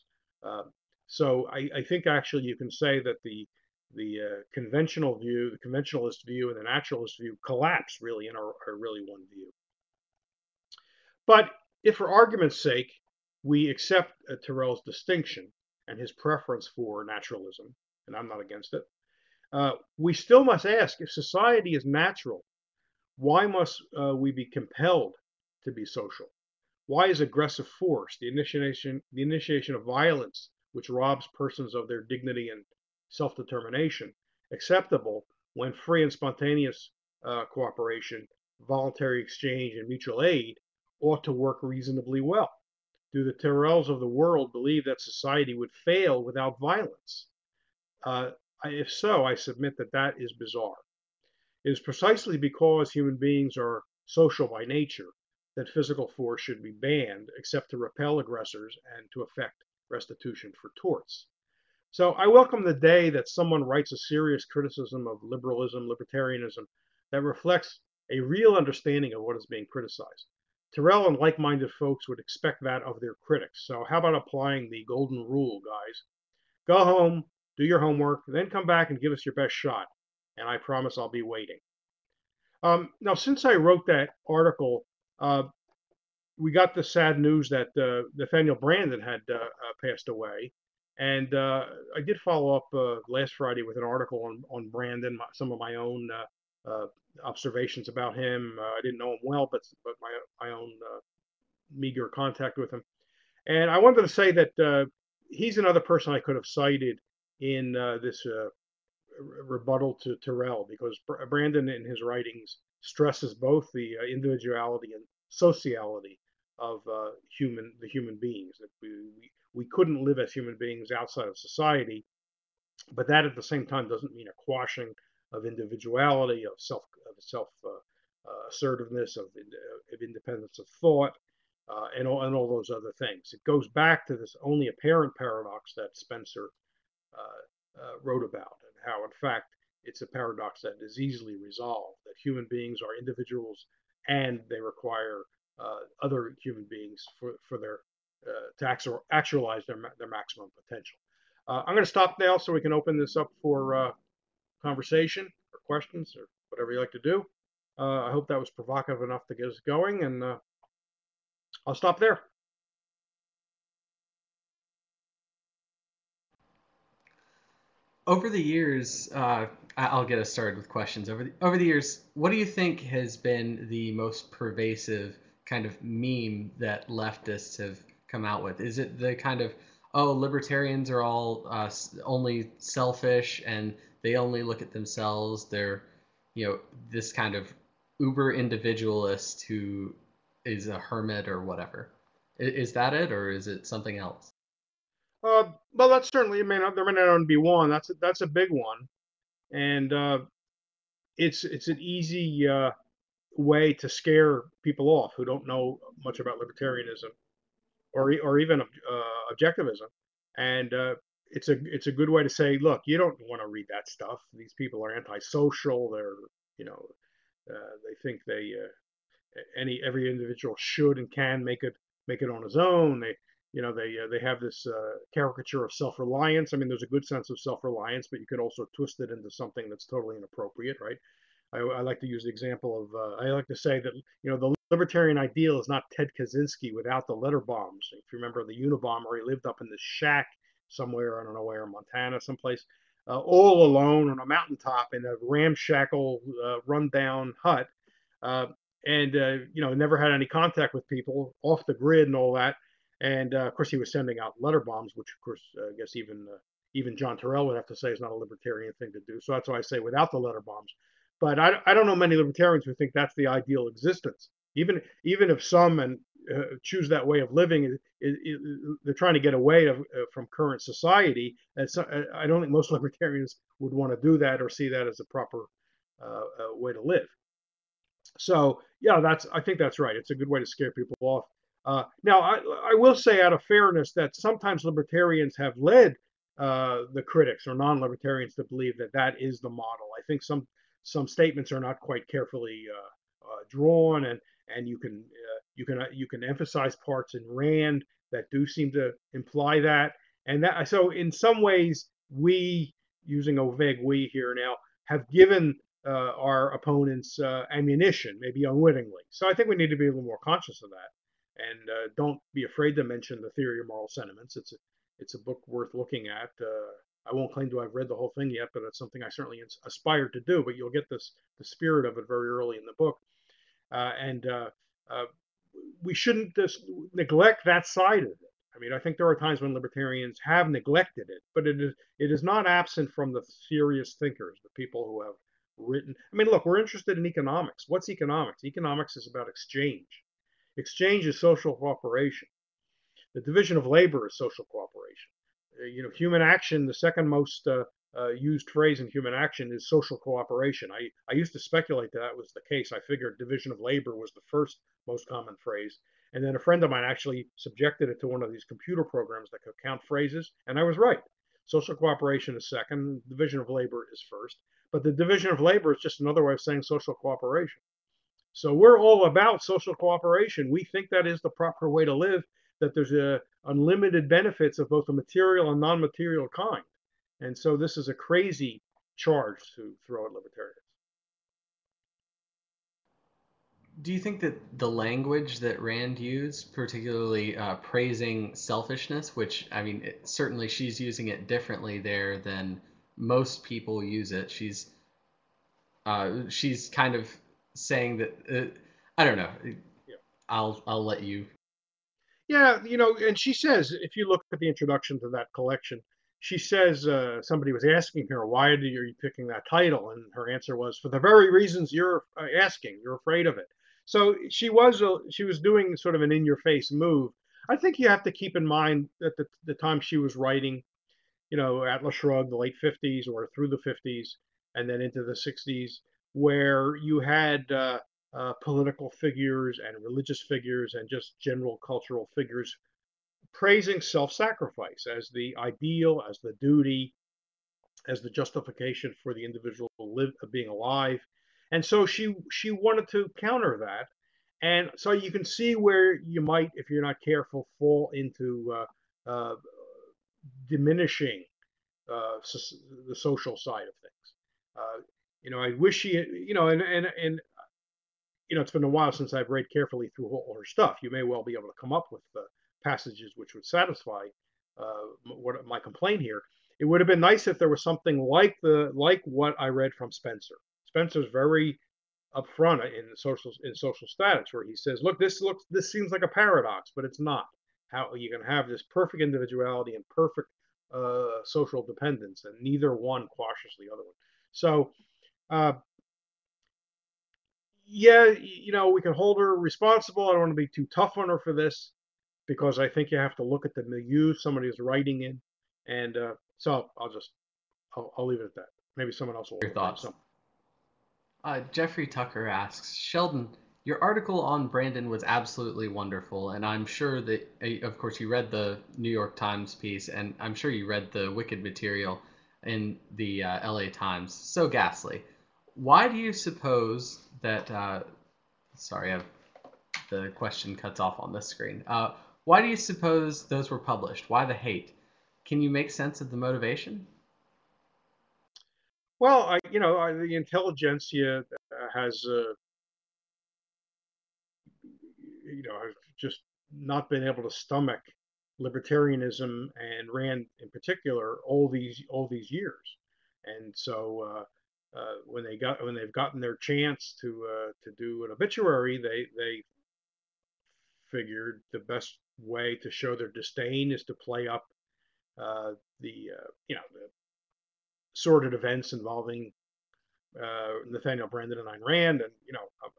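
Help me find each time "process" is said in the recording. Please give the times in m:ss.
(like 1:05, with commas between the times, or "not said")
not said.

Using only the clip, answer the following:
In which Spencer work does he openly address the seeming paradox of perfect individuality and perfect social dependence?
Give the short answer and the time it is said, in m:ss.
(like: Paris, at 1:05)
Social Statics, at 7:53.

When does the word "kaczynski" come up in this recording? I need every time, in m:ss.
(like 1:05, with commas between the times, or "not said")
3:56.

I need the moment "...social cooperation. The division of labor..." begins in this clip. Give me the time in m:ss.
5:41.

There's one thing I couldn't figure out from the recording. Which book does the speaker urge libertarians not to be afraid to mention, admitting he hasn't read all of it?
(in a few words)
The Theory of Moral Sentiments.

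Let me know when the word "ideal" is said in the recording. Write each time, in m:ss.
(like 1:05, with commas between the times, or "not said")
3:55, 4:23, 7:15.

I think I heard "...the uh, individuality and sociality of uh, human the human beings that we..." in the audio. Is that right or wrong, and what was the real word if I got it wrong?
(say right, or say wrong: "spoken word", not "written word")
right.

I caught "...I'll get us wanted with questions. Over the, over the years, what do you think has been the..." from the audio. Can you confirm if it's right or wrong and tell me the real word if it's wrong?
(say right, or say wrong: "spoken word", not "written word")
wrong: "started", not "wanted".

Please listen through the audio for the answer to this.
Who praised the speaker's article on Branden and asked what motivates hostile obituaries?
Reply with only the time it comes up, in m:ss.
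8:21.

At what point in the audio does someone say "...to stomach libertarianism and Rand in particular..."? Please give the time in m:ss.
8:57.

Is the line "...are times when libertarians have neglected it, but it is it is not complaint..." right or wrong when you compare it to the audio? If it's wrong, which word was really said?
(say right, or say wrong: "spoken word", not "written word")
wrong: "absent", not "complaint".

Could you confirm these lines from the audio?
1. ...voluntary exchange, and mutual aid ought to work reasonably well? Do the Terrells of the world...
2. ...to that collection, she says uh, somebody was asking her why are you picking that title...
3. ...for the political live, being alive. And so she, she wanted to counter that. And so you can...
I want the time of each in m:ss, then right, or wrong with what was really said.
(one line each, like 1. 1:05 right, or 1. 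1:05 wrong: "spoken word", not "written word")
1. 0:38 right
2. 6:45 right
3. 7:19 wrong: "individual", not "political".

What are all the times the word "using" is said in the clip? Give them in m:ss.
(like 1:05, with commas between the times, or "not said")
5:03, 6:30.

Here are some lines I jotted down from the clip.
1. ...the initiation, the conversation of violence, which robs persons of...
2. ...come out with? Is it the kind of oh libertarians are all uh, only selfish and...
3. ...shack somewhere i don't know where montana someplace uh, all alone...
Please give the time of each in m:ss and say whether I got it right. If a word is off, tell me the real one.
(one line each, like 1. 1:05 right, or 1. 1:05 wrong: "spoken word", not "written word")
1. 0:28 wrong: "initiation", not "conversation"
2. 2:58 right
3. 3:59 right.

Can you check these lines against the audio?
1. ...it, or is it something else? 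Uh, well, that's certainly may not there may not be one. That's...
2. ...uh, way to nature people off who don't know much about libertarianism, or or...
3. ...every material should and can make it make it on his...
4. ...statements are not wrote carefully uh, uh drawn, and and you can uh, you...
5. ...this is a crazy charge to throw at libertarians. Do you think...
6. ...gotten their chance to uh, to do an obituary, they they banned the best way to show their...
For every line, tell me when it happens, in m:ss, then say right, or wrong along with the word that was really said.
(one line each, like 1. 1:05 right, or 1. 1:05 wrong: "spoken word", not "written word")
1. 3:12 right
2. 3:22 wrong: "scare", not "nature"
3. 3:39 wrong: "individual", not "material"
4. 4:51 wrong: "quite", not "wrote"
5. 6:17 right
6. 9:05 wrong: "figured", not "banned".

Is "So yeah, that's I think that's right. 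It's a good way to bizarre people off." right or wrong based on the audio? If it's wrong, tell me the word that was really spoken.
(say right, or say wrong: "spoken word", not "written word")
wrong: "scare", not "bizarre".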